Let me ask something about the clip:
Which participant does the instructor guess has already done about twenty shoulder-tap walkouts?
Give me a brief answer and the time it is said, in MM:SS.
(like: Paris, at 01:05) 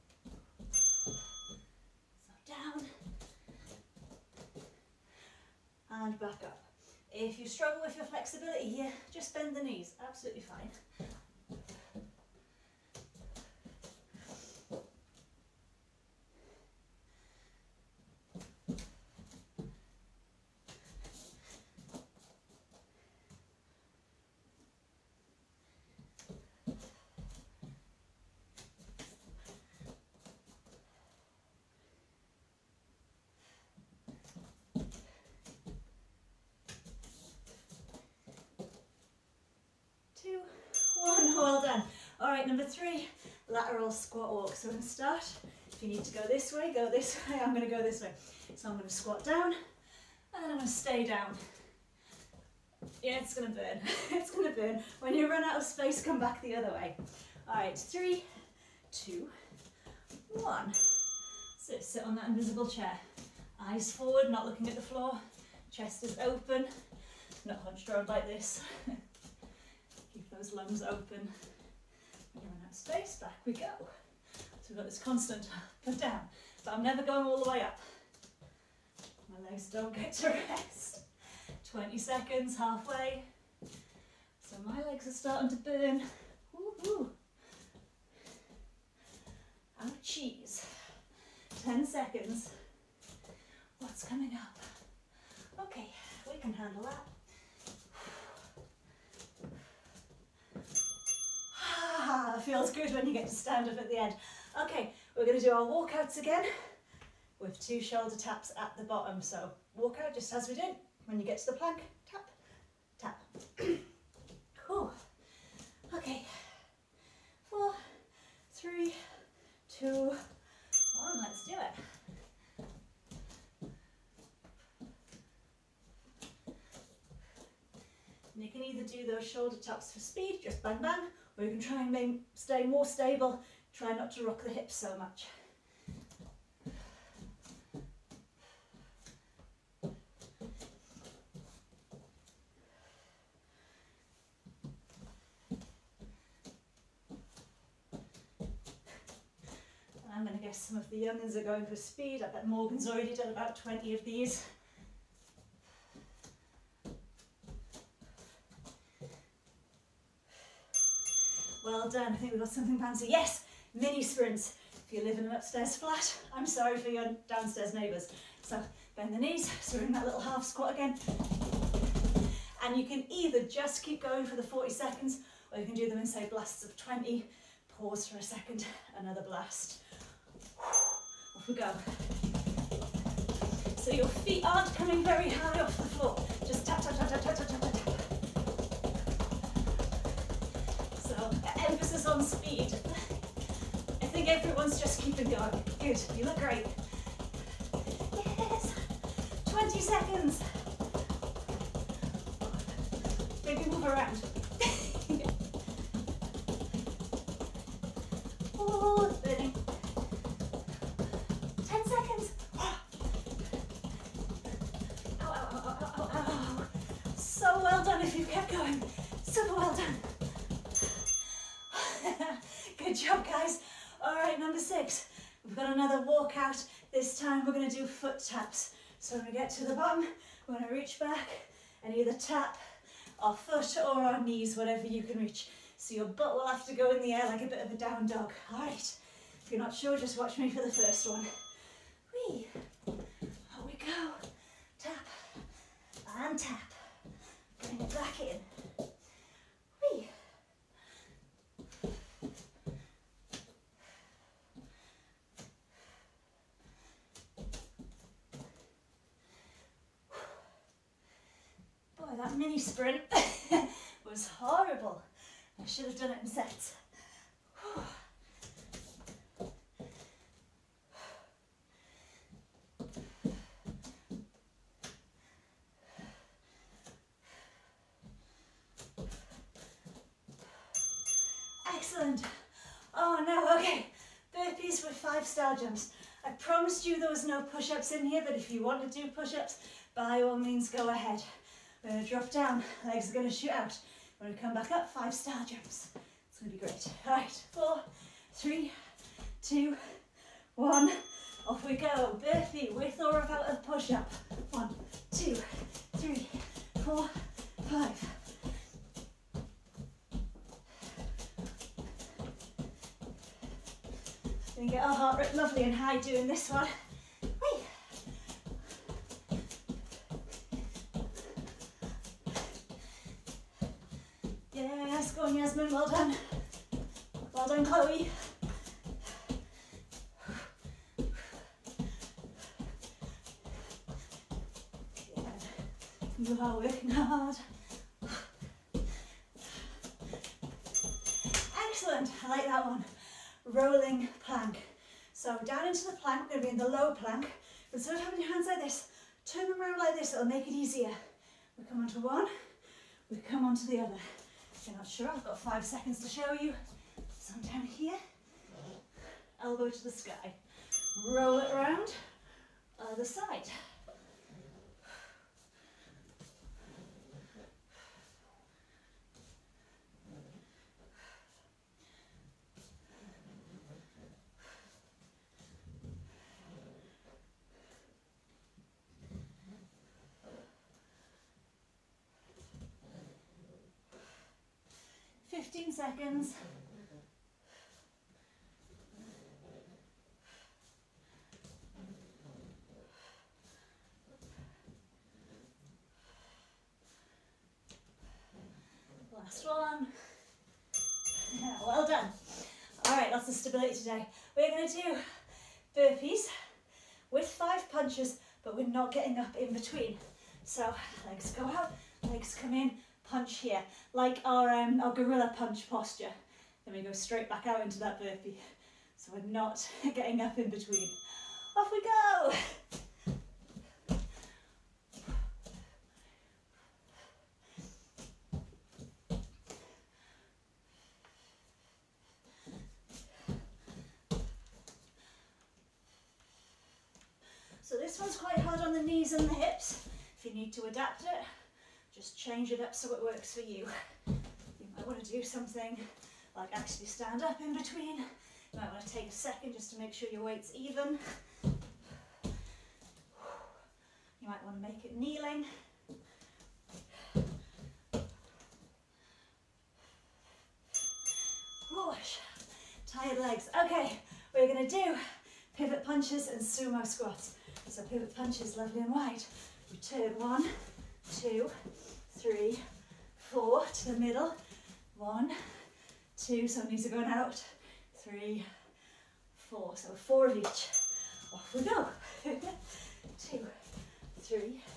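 Morgan, at 02:32.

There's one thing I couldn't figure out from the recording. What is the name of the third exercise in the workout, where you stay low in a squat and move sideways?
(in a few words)
Lateral squat walk.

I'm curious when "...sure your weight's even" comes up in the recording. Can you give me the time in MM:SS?
07:29.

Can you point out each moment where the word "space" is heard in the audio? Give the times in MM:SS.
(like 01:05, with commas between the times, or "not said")
00:55, 01:12.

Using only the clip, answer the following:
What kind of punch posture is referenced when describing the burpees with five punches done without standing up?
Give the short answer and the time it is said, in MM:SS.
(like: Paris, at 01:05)
Gorilla punch, at 06:54.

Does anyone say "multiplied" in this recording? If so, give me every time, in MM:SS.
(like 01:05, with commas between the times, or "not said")
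not said.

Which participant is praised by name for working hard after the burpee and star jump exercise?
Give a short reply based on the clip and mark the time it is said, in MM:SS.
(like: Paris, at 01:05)
Chloe, at 05:27.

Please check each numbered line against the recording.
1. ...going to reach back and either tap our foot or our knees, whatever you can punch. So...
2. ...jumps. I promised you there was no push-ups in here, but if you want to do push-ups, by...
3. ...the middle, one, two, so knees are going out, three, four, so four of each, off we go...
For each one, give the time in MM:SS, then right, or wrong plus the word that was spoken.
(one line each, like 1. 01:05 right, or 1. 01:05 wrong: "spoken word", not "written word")
1. 03:50 wrong: "reach", not "punch"
2. 04:45 right
3. 07:53 right.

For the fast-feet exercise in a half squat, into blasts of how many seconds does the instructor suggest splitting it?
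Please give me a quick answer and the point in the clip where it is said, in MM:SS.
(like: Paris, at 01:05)
20, at 02:56.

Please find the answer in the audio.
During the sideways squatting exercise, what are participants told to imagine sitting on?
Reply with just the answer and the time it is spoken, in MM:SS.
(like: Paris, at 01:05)
Invisible chair, at 01:02.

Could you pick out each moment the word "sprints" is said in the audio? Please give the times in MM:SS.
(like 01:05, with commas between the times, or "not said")
02:43, 04:22.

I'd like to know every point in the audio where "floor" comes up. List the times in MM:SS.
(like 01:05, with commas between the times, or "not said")
01:04, 03:05.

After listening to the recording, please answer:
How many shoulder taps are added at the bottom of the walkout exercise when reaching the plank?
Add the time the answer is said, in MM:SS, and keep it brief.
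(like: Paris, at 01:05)
2, at 01:47.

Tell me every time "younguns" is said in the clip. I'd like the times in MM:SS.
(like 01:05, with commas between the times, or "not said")
02:30.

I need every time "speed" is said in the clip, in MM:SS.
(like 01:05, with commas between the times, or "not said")
02:09, 02:31, 03:12.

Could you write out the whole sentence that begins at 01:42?
feels good when you get to stand up at the end.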